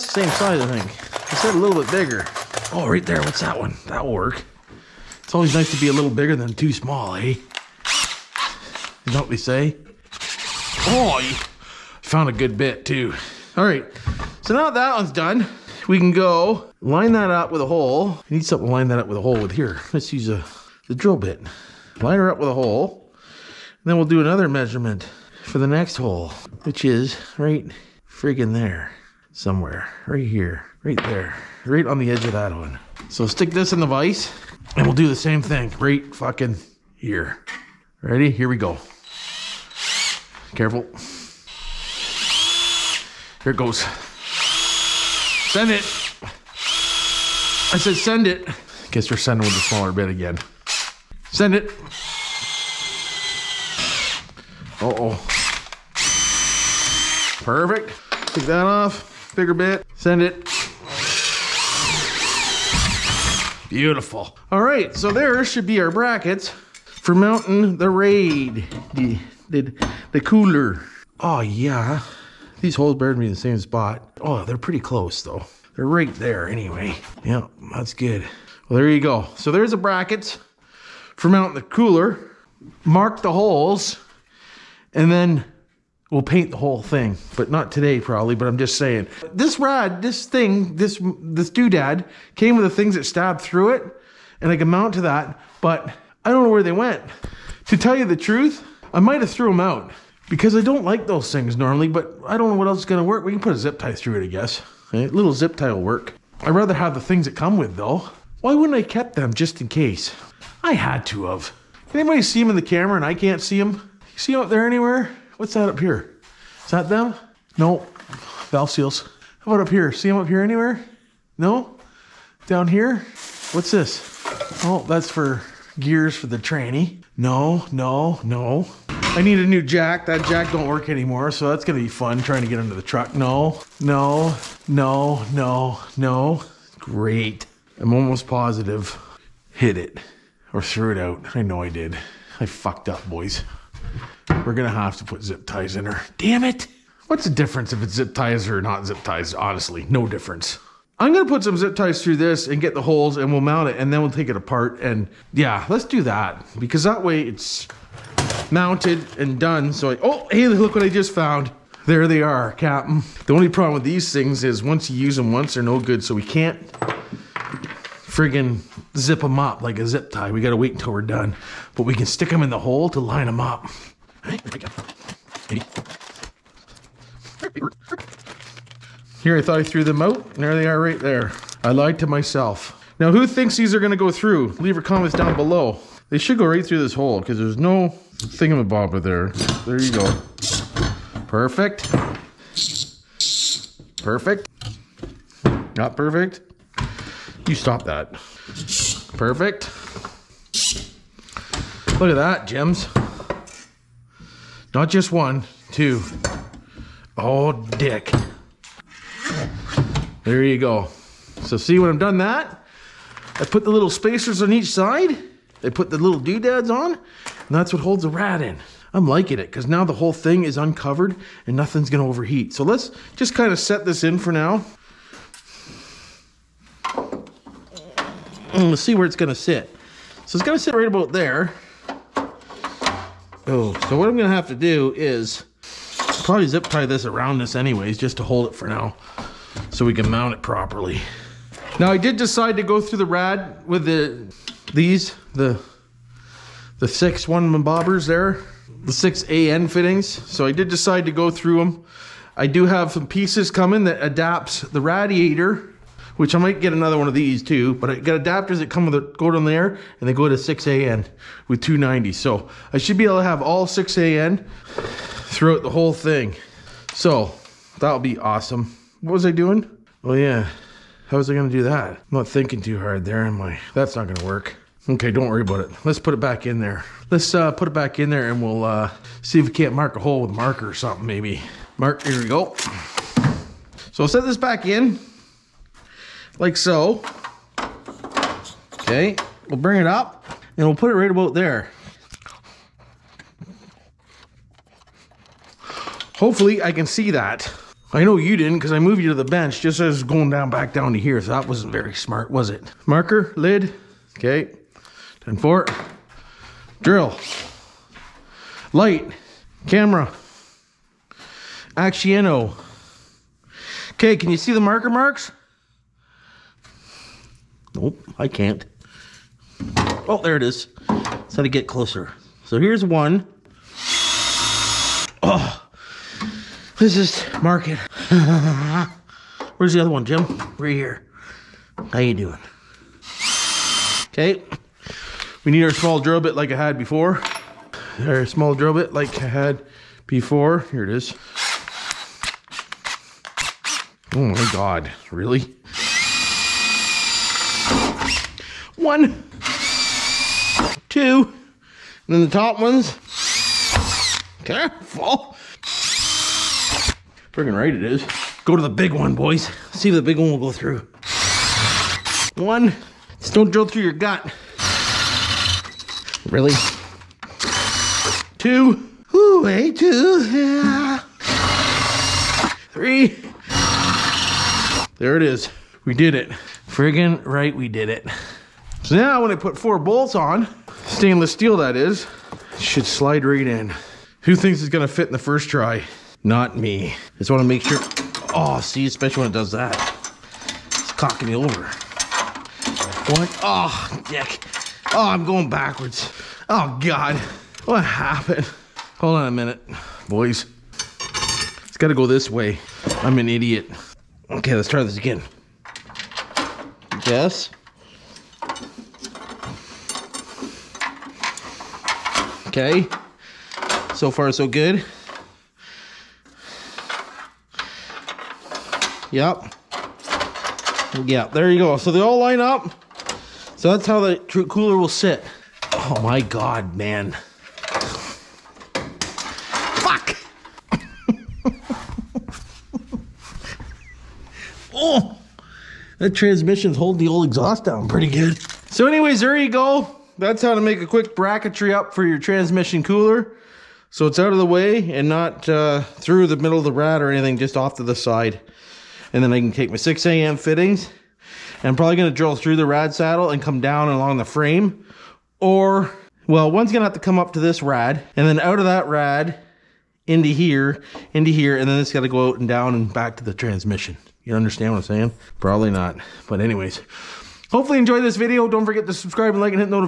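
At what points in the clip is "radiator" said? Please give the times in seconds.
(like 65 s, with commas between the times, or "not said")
254 s.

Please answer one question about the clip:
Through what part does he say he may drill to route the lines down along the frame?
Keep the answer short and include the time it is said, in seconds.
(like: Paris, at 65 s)
rad saddle, at 452 s.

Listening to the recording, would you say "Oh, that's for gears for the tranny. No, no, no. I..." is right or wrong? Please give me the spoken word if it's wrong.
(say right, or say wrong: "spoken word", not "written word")
right.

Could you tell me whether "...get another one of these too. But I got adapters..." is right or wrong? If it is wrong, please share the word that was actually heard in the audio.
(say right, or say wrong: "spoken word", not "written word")
right.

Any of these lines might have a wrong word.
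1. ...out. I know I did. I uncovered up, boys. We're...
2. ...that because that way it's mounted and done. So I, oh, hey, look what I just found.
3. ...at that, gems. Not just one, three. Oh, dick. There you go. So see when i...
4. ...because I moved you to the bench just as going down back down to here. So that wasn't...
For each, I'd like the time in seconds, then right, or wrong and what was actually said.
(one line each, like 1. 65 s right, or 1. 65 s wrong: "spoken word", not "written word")
1. 140 s wrong: "fucked", not "uncovered"
2. 156 s right
3. 202 s wrong: "two", not "three"
4. 298 s right.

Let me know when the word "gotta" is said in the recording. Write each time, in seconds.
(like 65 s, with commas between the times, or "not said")
170 s, 401 s.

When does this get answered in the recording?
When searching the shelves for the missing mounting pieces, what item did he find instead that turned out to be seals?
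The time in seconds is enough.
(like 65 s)
118 s.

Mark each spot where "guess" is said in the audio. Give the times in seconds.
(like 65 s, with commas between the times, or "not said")
48 s, 104 s, 407 s.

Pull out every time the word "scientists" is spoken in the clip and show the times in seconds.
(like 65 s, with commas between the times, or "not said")
not said.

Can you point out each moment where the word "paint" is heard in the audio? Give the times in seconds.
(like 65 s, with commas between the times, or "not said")
86 s.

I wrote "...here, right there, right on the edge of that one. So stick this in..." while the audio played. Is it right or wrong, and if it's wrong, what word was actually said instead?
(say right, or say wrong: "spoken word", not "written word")
right.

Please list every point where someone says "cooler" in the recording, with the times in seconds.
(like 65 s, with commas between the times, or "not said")
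70 s, 81 s, 424 s, 442 s.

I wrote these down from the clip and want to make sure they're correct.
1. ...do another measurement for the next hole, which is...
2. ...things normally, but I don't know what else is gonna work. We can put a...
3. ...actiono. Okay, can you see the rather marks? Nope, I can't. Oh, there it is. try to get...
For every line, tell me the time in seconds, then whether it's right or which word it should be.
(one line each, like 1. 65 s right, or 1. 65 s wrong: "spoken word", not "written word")
1. 24 s right
2. 101 s right
3. 311 s wrong: "marker", not "rather".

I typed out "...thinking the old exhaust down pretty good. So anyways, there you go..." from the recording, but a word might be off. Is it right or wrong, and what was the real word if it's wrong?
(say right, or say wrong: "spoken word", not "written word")
wrong: "holding", not "thinking".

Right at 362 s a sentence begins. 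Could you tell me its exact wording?
One, just don't drill through your gut.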